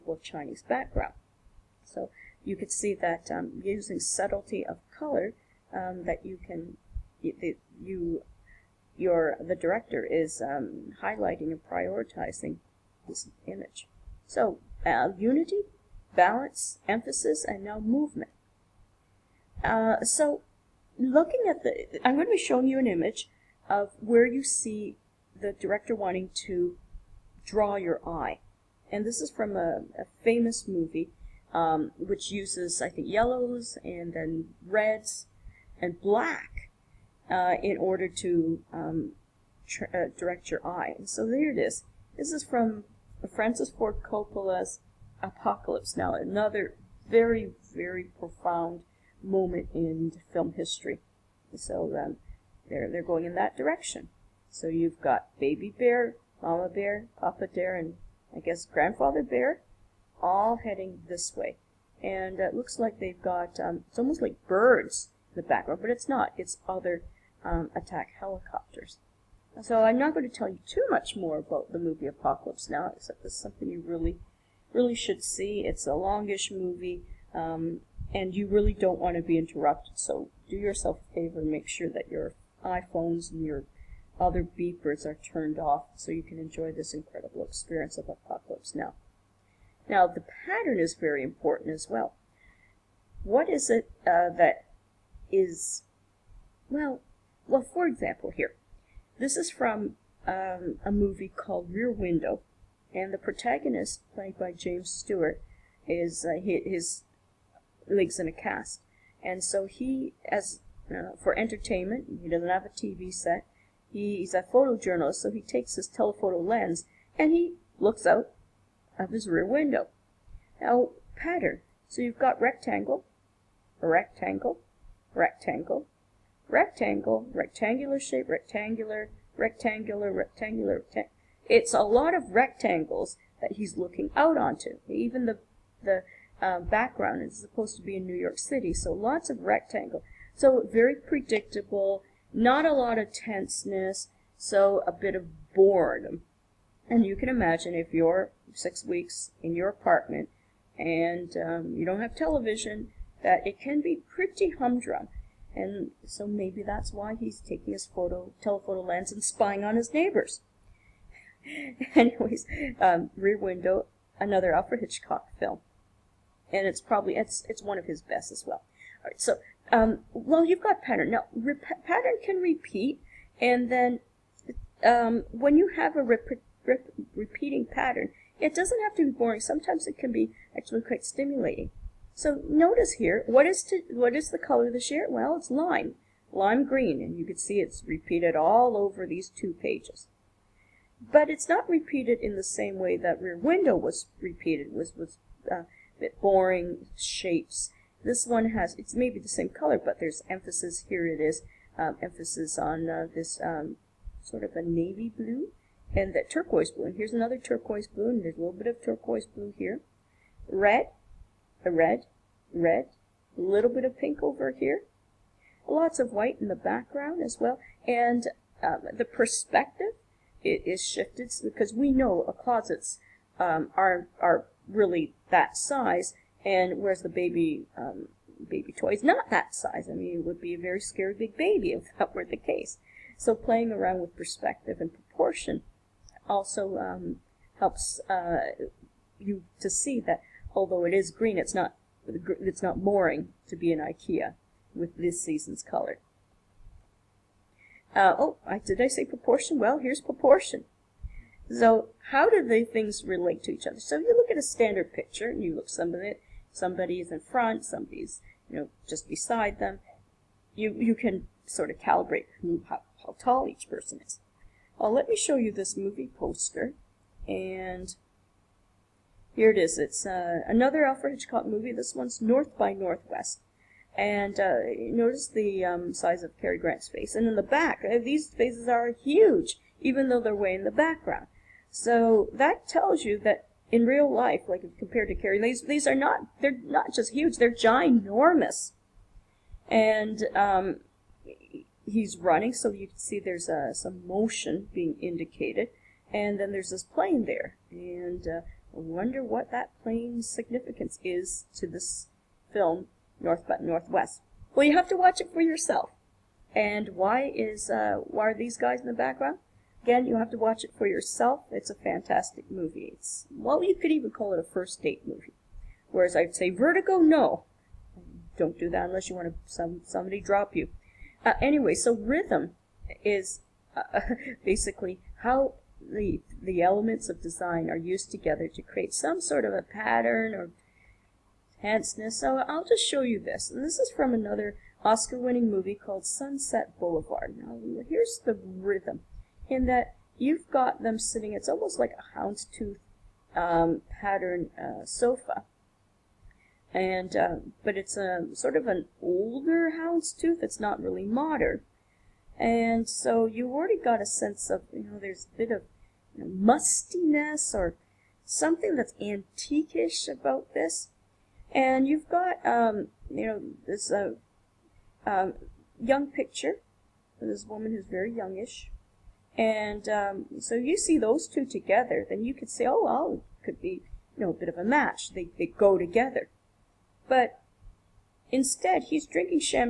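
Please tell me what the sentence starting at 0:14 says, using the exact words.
So uh, unity, balance, emphasis, and now movement.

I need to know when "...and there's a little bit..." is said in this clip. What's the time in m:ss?
3:28.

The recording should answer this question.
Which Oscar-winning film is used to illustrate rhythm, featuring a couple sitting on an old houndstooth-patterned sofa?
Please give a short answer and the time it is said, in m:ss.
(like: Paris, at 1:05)
Sunset Boulevard, at 5:36.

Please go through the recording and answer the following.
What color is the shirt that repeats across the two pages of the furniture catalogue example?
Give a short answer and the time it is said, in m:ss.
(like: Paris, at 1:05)
Lime green, at 3:05.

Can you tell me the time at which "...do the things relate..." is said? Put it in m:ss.
4:12.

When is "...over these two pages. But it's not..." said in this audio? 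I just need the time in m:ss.
3:08.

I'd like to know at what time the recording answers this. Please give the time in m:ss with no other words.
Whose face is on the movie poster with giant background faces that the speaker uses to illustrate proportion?
4:36.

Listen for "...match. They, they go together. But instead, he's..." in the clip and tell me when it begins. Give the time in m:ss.
6:14.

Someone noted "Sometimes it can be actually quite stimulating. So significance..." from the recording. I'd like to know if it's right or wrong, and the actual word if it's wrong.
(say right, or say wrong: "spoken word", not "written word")
wrong: "notice", not "significance".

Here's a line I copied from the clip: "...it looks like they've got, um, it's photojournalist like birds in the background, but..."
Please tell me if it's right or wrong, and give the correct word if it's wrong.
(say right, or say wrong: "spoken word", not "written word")
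wrong: "almost", not "photojournalist".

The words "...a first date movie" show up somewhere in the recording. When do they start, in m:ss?
5:14.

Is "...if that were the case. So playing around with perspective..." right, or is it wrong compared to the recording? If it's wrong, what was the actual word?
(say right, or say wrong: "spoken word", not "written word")
right.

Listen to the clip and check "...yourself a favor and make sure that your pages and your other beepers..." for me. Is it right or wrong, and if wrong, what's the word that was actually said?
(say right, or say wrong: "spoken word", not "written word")
wrong: "iPhones", not "pages".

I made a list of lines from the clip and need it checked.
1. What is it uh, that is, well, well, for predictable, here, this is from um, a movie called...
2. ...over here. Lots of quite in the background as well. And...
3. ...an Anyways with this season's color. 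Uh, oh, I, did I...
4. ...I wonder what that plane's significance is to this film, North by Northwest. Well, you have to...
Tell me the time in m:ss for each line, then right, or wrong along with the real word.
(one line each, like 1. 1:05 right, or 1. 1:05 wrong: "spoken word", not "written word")
1. 1:33 wrong: "example", not "predictable"
2. 3:34 wrong: "white", not "quite"
3. 4:03 wrong: "IKEA", not "Anyways"
4. 4:58 right.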